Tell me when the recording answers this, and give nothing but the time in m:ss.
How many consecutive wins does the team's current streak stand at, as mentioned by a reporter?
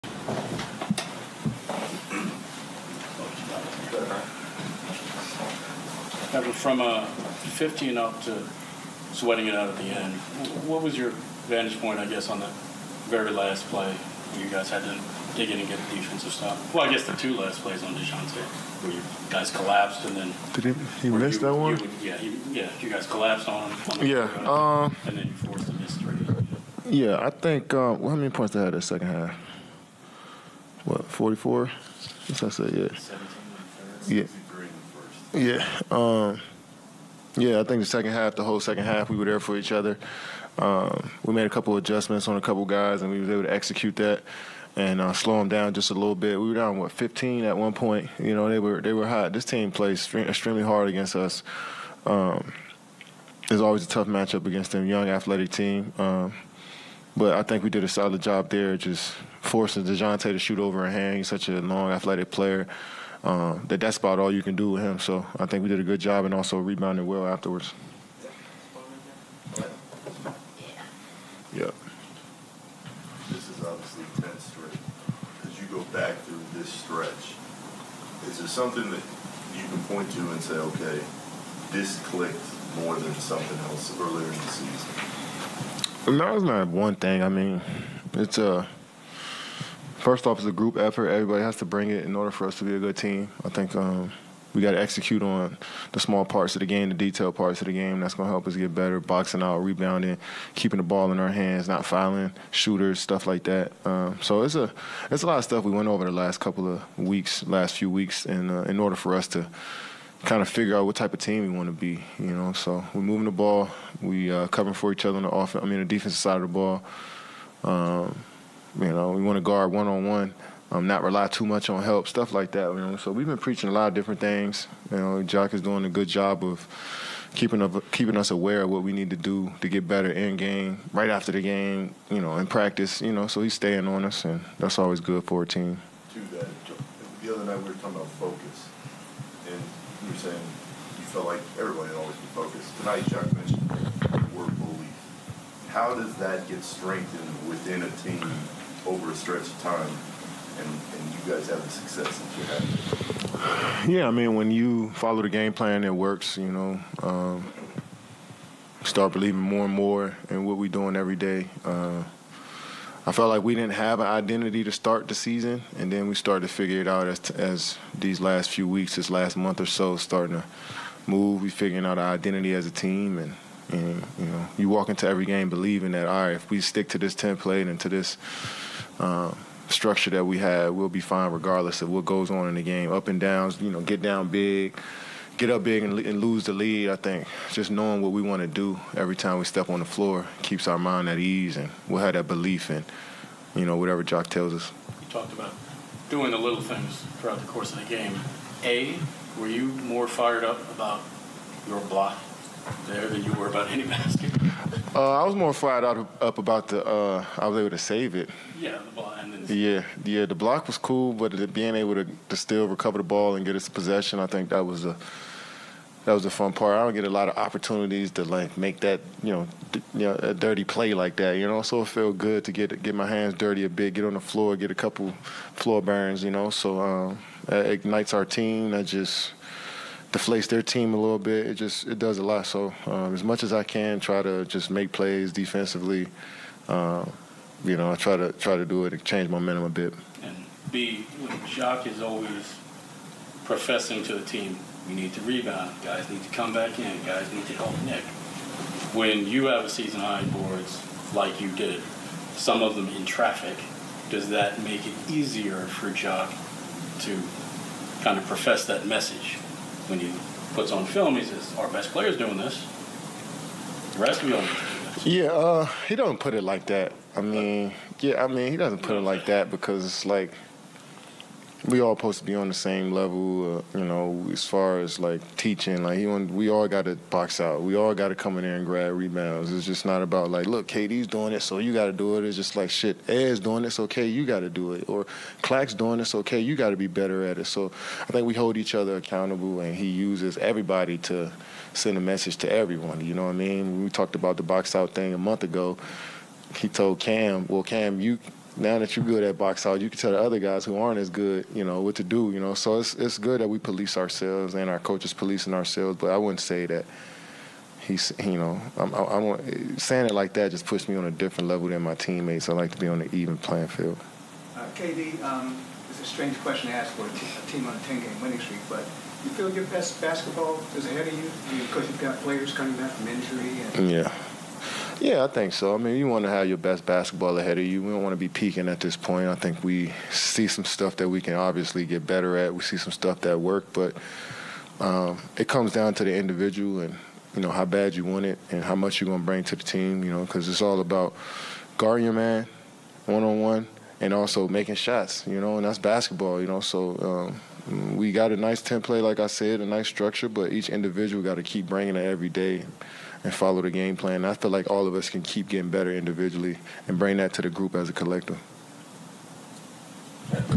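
1:14.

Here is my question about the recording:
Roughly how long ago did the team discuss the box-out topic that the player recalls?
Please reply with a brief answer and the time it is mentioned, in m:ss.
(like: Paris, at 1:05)
a month ago, at 4:55.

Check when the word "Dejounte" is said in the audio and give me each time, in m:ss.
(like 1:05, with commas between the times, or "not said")
0:17, 0:59.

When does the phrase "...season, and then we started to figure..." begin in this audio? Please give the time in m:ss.
2:45.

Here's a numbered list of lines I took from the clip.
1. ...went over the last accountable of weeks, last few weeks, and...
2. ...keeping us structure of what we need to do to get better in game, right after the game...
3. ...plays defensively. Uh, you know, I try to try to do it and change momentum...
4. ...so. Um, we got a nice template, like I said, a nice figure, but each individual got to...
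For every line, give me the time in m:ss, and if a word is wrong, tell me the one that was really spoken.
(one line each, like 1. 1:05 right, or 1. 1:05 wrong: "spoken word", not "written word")
1. 1:45 wrong: "couple", not "accountable"
2. 2:07 wrong: "aware", not "structure"
3. 3:54 right
4. 5:46 wrong: "structure", not "figure".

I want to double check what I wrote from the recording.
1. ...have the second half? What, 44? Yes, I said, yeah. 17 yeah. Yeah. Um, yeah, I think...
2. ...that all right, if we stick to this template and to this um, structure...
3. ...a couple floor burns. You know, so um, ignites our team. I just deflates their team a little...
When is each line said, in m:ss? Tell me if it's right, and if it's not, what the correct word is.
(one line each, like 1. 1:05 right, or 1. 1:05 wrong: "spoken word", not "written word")
1. 0:28 right
2. 2:55 right
3. 3:44 right.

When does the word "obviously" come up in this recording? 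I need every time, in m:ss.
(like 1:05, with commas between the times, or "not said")
1:13, 5:31.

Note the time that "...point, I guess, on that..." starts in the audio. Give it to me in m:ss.
0:11.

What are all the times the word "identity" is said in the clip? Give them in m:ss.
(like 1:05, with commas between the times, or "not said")
2:44, 2:52.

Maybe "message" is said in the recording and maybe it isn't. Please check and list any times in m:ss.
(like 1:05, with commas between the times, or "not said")
4:18, 4:52.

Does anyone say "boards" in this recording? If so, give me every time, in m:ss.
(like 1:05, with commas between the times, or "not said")
4:10.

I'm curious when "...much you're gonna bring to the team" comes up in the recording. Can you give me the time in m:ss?
5:38.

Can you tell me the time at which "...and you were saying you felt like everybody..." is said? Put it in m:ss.
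2:19.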